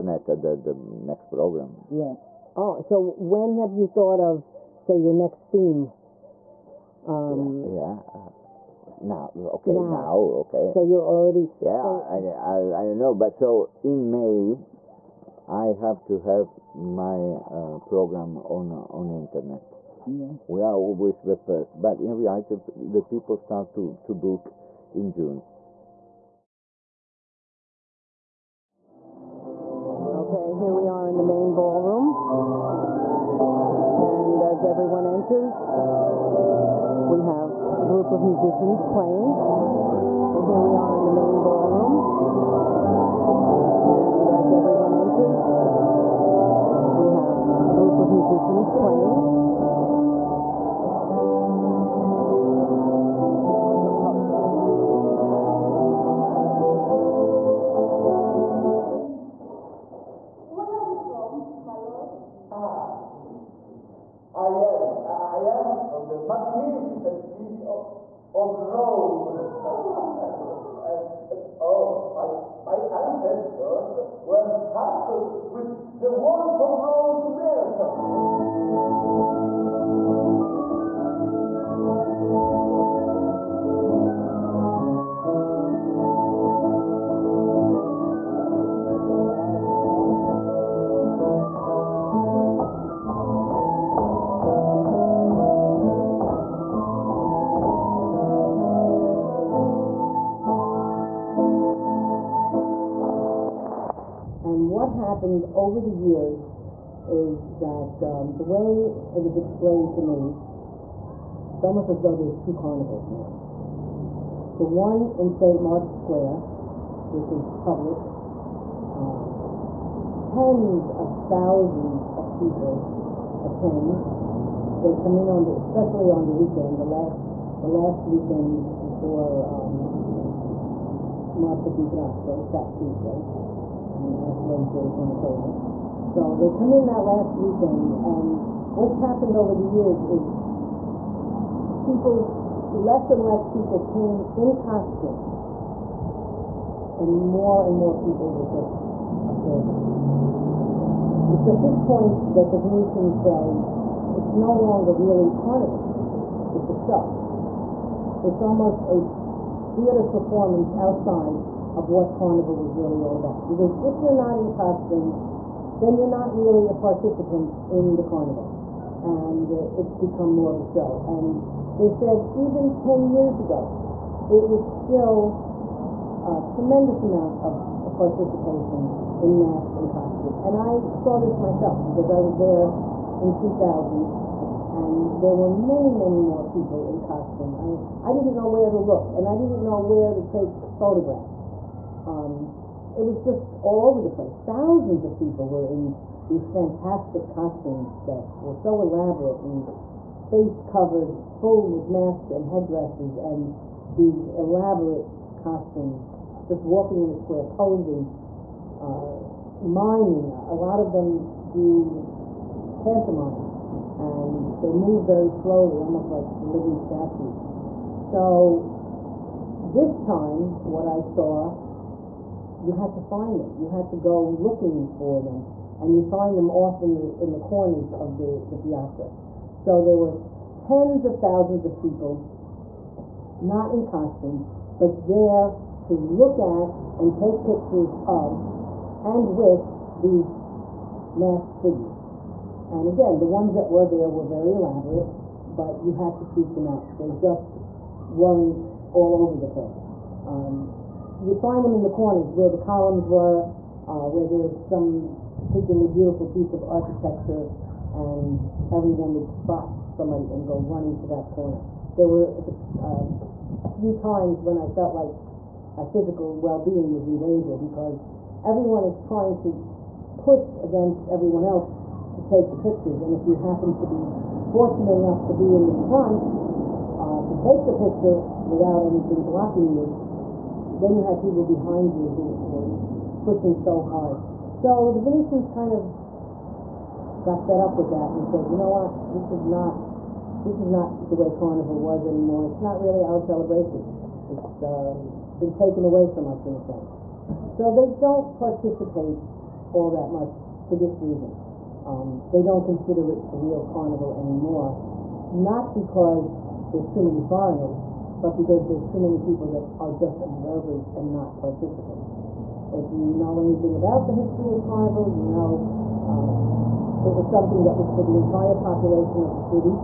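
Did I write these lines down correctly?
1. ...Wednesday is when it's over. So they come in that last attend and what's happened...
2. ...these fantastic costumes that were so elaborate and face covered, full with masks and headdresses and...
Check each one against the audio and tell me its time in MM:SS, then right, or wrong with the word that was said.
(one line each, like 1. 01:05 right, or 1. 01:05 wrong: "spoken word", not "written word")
1. 02:14 wrong: "weekend", not "attend"
2. 03:16 right.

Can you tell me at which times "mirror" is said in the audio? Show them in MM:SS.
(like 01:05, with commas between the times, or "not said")
not said.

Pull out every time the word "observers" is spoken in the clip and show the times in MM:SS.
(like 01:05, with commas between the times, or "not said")
02:29, 05:10.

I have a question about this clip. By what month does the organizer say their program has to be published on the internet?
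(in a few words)
May.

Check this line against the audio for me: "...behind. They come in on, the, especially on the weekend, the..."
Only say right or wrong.
wrong.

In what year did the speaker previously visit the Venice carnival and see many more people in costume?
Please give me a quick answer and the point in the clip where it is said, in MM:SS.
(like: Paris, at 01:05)
2000, at 03:03.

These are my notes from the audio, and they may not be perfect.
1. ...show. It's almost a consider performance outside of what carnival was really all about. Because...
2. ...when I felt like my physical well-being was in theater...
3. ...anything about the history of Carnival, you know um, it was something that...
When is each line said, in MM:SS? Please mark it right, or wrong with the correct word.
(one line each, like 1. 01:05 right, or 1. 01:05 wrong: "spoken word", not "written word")
1. 02:36 wrong: "theater", not "consider"
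2. 04:24 wrong: "danger", not "theater"
3. 05:13 right.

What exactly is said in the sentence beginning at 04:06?
They just weren't all over the place.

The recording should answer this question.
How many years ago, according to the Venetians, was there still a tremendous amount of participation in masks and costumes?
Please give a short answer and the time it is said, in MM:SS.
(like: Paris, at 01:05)
10, at 02:52.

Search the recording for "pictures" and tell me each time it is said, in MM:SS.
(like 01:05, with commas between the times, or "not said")
03:57, 04:32, 04:37.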